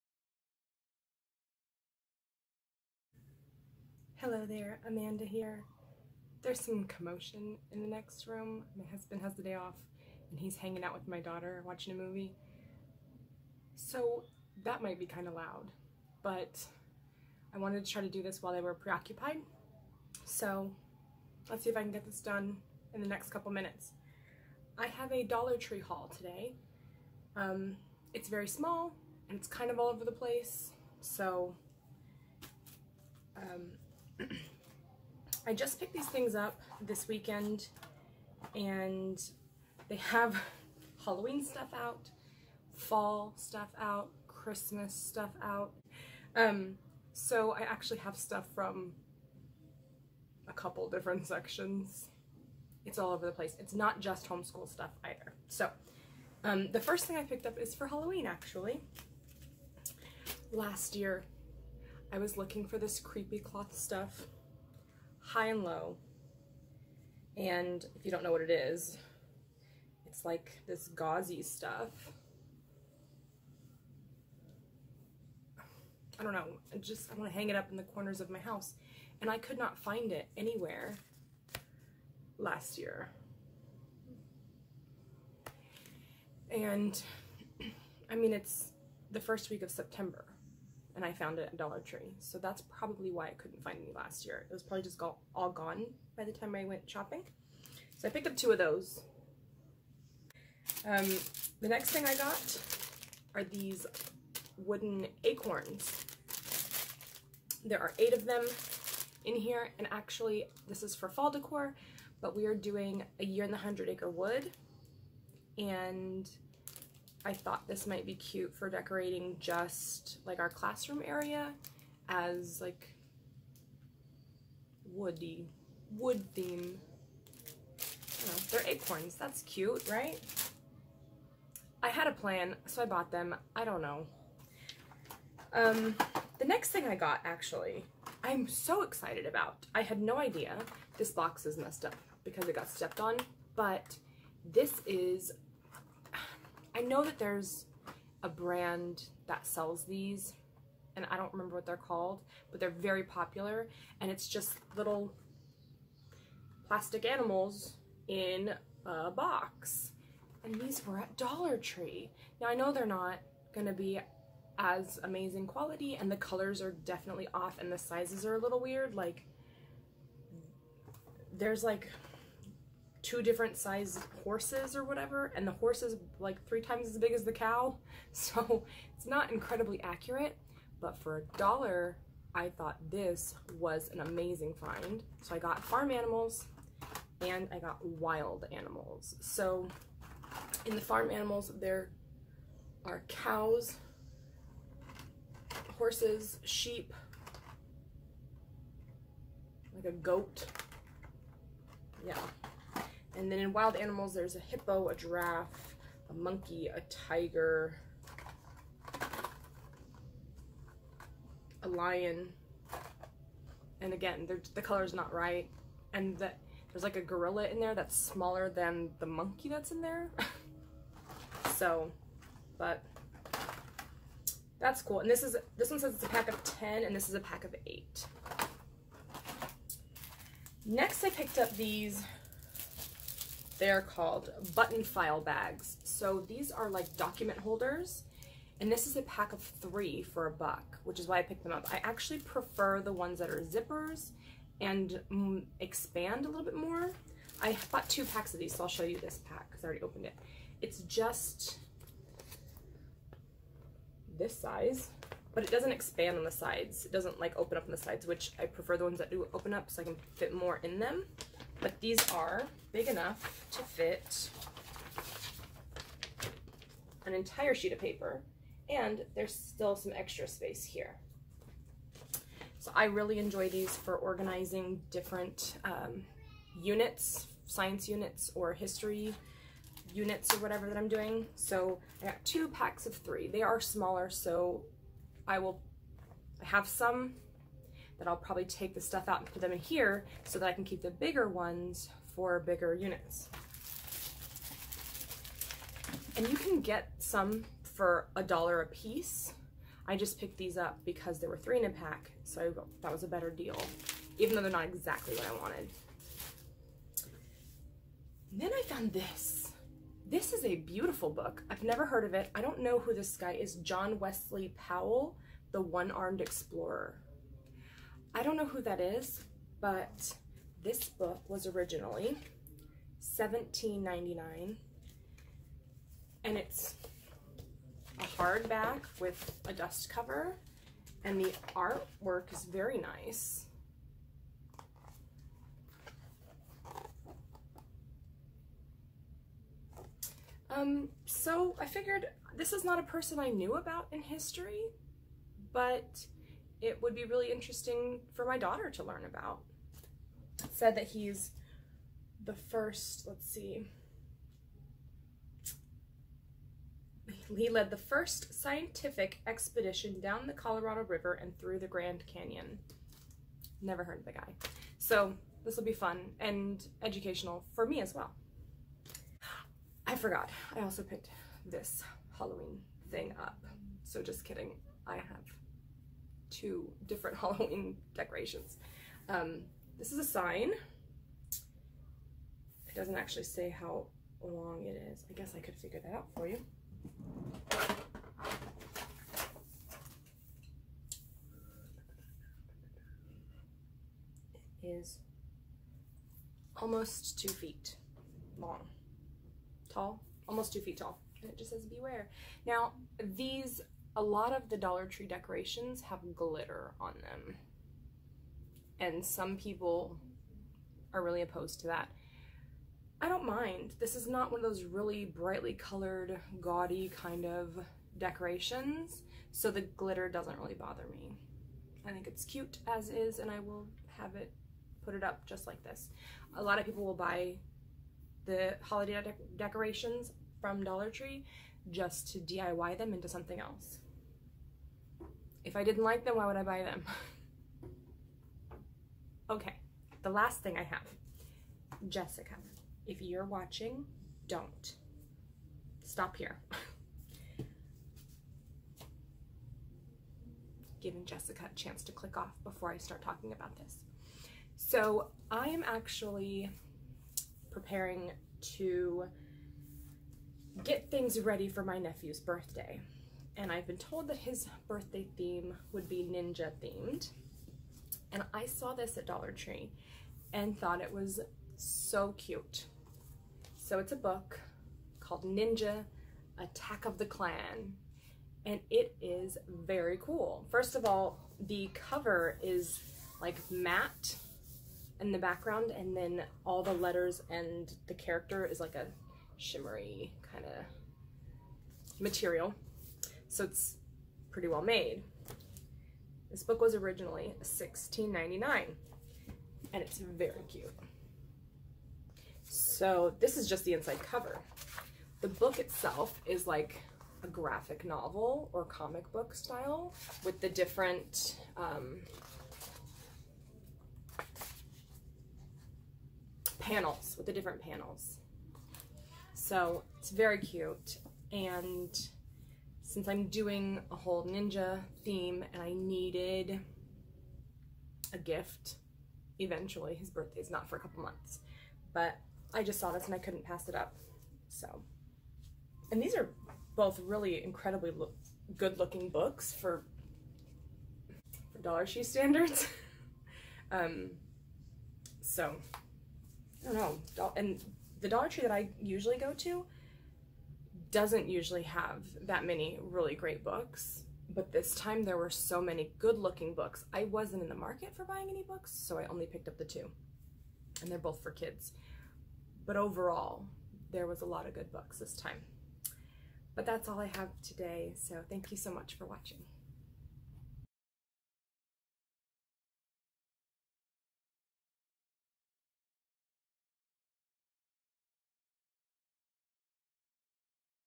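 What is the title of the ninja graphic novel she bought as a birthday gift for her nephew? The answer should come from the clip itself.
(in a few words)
Ninja Attack of the Clan.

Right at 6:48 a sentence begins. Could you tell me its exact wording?
And some people are really opposed to that.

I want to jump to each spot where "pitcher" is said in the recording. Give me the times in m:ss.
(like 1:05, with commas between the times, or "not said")
not said.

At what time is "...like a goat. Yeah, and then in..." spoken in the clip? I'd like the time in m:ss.
3:19.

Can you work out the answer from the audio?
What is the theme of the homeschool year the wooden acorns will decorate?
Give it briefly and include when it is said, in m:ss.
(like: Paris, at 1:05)
a year in the hundred acre wood, at 1:53.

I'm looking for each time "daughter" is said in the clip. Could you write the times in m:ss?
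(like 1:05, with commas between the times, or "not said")
0:11, 5:48.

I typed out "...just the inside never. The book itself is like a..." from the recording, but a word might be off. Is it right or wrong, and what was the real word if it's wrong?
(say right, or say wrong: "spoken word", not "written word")
wrong: "cover", not "never".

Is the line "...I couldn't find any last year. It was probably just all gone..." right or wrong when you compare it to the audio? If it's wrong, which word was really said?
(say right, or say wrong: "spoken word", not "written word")
right.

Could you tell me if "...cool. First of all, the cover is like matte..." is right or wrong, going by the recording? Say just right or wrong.
right.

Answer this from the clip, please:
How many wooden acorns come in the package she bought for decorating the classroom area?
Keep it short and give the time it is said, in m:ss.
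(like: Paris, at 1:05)
8, at 1:47.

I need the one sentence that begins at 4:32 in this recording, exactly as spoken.
So I really enjoy these for organizing different um, units, science units or history units or whatever that I'm doing.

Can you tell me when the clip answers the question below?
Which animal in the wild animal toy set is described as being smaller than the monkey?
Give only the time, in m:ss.
3:37.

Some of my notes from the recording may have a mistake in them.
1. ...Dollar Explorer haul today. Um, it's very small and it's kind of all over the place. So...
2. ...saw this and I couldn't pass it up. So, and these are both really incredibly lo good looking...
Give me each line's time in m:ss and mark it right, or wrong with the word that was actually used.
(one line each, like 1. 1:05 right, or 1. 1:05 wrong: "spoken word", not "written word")
1. 0:25 wrong: "Tree", not "Explorer"
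2. 8:52 right.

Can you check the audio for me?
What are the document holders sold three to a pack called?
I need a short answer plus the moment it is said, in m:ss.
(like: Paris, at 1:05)
button file bags, at 3:54.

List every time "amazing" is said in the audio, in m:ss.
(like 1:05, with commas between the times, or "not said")
2:45, 3:03.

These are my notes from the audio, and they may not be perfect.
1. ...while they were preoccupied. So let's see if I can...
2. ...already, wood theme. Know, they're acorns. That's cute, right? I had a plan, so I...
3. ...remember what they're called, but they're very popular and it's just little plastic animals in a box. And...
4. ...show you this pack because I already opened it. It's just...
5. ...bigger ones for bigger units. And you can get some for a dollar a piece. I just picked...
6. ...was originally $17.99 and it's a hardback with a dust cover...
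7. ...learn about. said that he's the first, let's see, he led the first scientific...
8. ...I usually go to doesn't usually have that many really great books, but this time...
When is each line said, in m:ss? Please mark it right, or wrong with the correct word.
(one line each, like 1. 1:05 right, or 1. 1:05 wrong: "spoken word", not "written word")
1. 0:18 right
2. 2:04 wrong: "woody", not "already"
3. 2:31 right
4. 4:08 right
5. 4:50 right
6. 5:21 right
7. 5:48 right
8. 9:08 right.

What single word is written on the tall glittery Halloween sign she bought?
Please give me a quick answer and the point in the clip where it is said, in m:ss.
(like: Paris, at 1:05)
beware, at 6:41.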